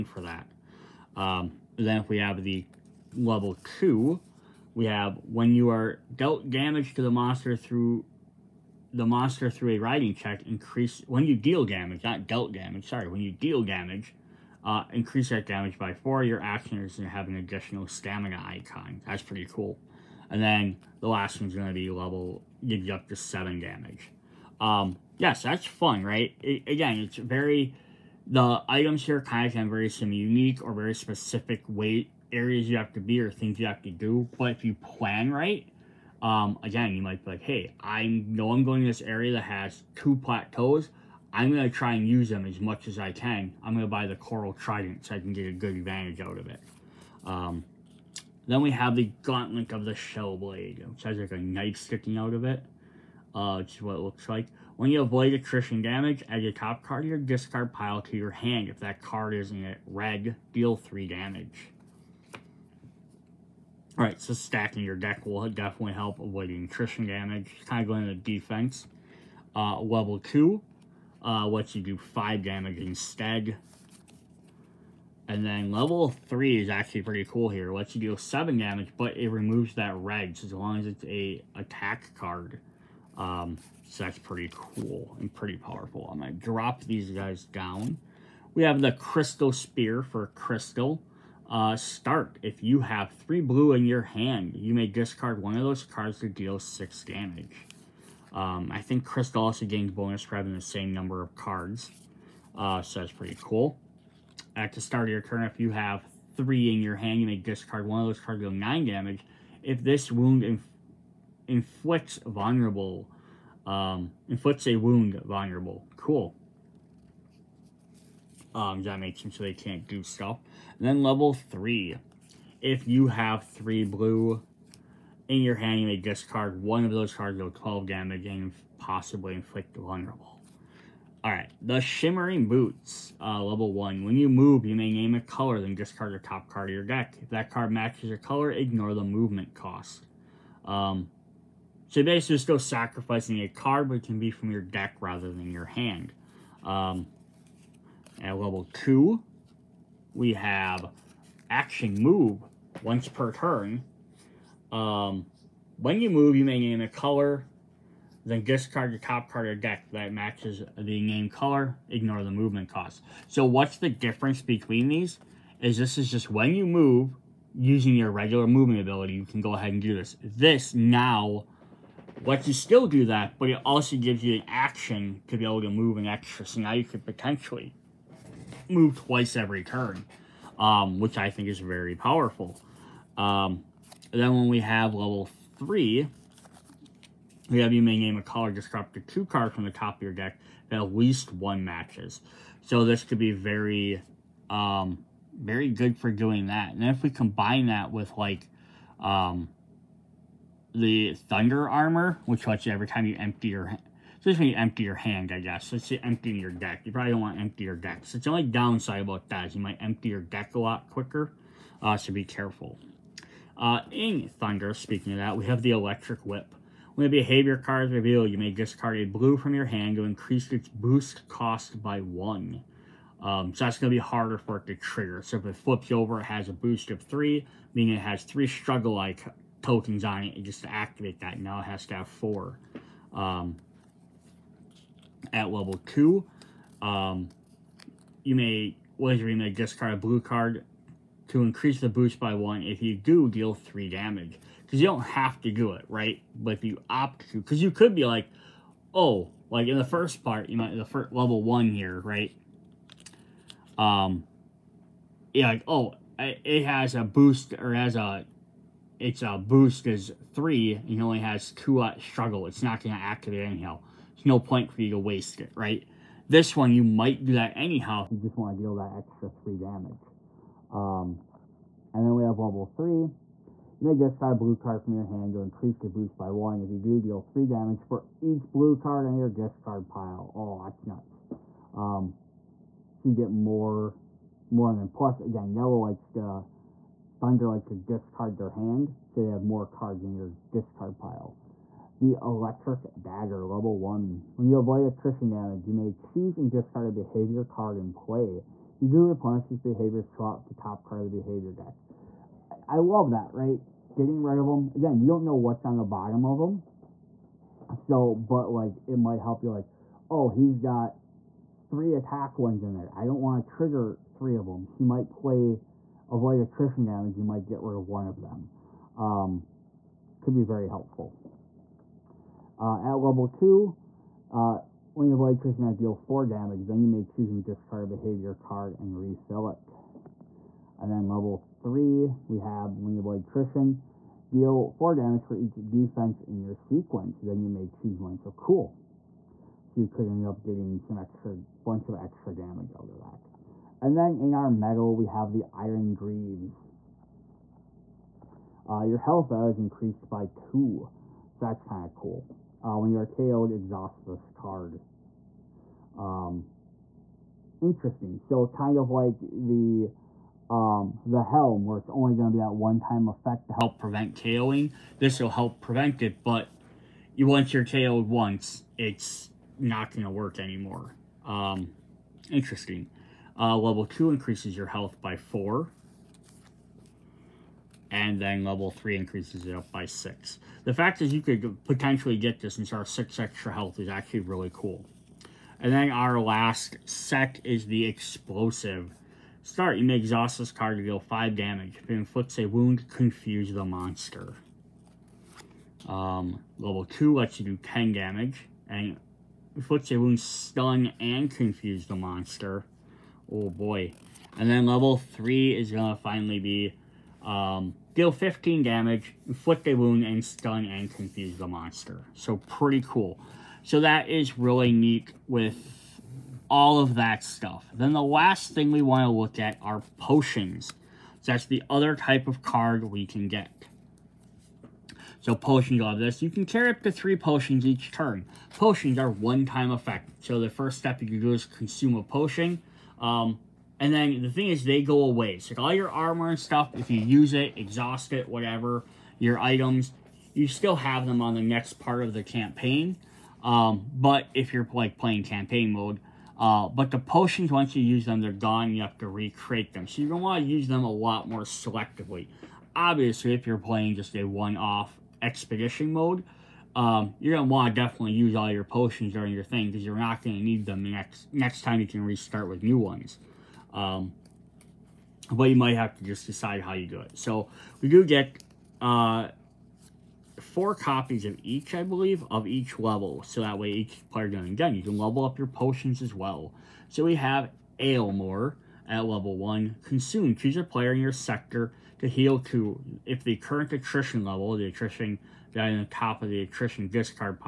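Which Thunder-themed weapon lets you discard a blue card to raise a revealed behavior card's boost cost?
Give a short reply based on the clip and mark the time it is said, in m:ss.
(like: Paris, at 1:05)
Electric Whip, at 3:35.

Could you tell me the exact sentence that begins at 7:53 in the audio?
So that way each player doing done.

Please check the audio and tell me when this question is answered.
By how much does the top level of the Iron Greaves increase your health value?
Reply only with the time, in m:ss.
6:18.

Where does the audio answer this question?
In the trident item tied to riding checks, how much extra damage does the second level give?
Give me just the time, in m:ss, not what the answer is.
0:14.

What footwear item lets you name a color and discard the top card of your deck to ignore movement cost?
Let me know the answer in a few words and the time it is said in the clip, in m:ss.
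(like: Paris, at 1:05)
Shimmering Boots, at 2:11.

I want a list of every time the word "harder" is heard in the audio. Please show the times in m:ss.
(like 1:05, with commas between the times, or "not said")
3:43.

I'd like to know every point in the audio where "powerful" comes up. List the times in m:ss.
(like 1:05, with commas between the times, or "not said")
1:25, 3:01.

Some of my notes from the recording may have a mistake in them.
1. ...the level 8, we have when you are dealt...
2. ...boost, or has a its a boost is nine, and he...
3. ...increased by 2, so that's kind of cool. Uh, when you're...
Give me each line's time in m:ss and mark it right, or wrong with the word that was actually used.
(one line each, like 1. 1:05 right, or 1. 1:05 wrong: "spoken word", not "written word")
1. 0:02 wrong: "2", not "8"
2. 4:17 wrong: "three", not "nine"
3. 5:49 right.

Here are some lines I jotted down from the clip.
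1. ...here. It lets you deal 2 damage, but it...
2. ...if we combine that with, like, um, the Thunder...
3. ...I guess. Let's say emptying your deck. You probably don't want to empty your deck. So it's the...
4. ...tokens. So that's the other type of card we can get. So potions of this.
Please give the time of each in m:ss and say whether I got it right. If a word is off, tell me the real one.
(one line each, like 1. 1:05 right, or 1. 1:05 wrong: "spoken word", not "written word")
1. 1:17 wrong: "7", not "2"
2. 3:16 right
3. 3:25 right
4. 6:59 wrong: "potions", not "tokens".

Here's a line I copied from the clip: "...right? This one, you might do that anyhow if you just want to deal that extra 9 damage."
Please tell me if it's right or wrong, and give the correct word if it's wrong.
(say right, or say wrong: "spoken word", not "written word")
wrong: "3", not "9".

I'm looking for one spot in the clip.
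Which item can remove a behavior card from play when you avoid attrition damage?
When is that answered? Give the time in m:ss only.
4:52.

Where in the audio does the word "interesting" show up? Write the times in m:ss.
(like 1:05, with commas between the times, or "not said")
5:57, 6:12.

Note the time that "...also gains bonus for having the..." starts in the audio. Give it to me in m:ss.
1:39.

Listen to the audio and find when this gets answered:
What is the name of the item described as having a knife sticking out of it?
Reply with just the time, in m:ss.
0:49.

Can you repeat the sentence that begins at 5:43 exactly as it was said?
And then in our metal, we have the Iron Greaves.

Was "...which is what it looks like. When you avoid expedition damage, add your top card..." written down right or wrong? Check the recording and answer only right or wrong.
wrong.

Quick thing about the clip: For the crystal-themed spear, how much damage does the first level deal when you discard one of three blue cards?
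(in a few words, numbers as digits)
6.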